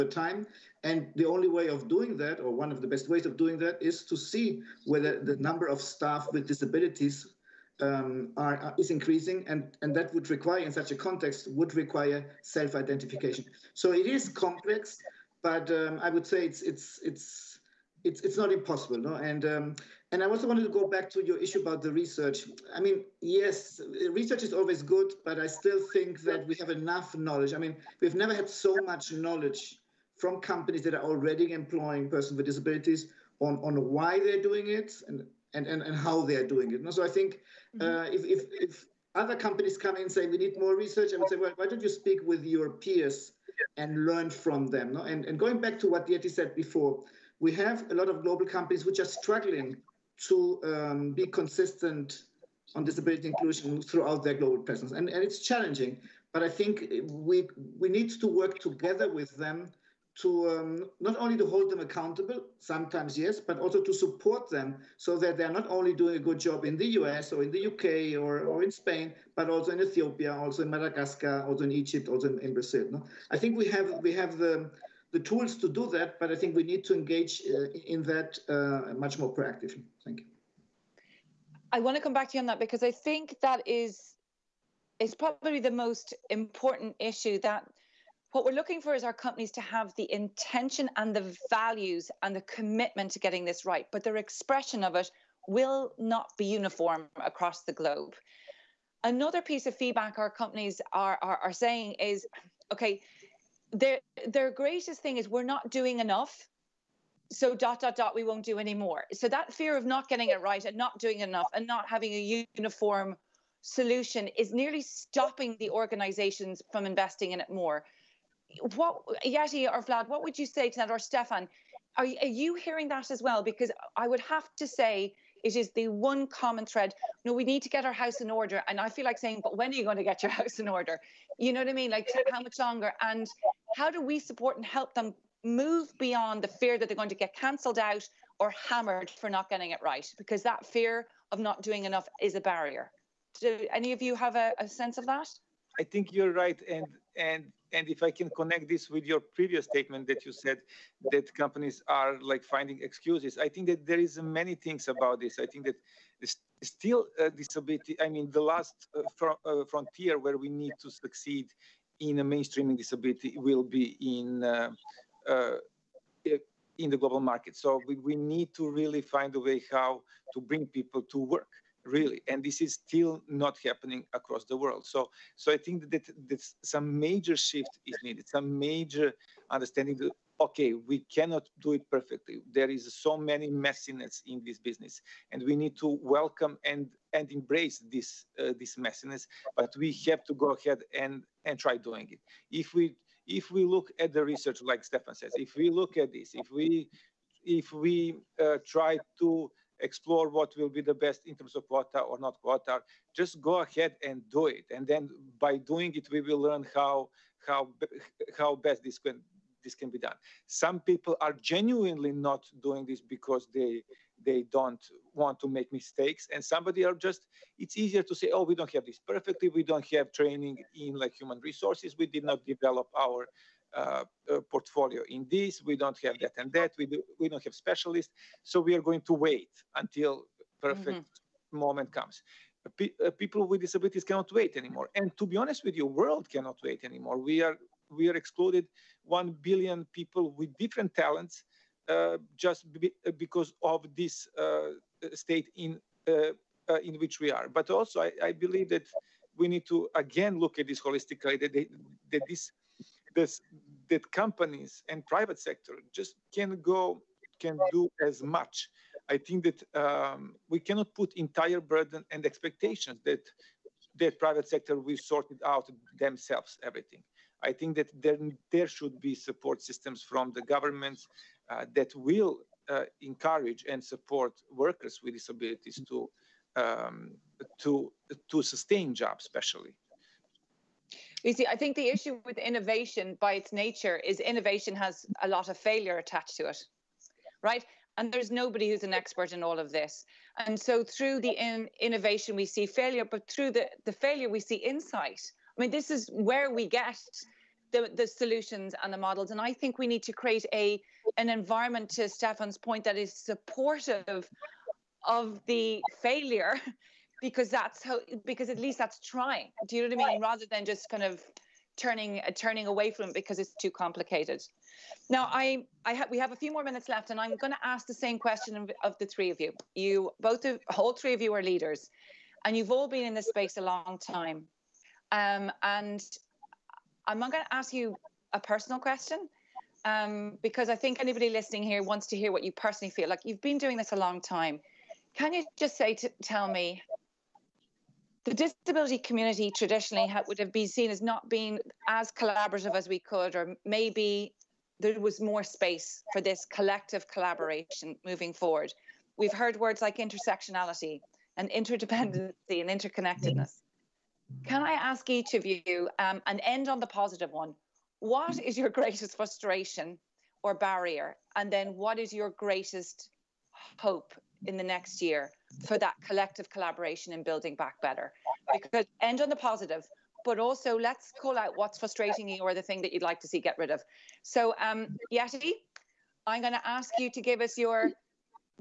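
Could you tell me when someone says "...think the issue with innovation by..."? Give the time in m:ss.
4:41.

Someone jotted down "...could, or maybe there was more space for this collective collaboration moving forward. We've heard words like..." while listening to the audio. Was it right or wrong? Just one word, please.
right.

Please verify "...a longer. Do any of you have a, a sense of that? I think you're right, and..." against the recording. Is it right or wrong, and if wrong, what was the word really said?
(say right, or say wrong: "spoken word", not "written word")
wrong: "barrier", not "longer".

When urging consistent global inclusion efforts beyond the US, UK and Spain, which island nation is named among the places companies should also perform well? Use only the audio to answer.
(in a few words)
Madagascar.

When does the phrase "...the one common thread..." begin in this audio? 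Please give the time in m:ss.
2:05.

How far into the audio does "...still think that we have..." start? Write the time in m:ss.
0:25.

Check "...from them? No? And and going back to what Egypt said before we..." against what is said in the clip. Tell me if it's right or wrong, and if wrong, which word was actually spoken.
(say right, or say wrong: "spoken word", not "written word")
wrong: "Yeti", not "Egypt".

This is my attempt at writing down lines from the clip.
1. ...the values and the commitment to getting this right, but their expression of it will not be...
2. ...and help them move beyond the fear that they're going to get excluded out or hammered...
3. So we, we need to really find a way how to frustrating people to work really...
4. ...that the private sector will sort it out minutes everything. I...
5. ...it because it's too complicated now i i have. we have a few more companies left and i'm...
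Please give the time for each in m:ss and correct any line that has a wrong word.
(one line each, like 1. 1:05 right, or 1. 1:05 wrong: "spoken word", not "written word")
1. 1:31 right
2. 2:14 wrong: "cancelled", not "excluded"
3. 2:47 wrong: "bring", not "frustrating"
4. 4:23 wrong: "themselves", not "minutes"
5. 5:13 wrong: "minutes", not "companies".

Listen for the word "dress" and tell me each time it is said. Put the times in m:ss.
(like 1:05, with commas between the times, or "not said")
not said.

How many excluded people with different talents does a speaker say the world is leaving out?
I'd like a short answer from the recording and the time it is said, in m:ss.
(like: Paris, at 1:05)
one billion, at 3:59.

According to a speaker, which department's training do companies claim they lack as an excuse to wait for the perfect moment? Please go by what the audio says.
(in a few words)
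human resources.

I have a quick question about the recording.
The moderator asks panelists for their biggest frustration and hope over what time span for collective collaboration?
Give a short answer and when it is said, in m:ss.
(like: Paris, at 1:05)
the next year, at 6:04.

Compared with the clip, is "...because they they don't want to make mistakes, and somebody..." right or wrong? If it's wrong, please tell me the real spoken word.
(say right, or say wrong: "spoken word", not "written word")
right.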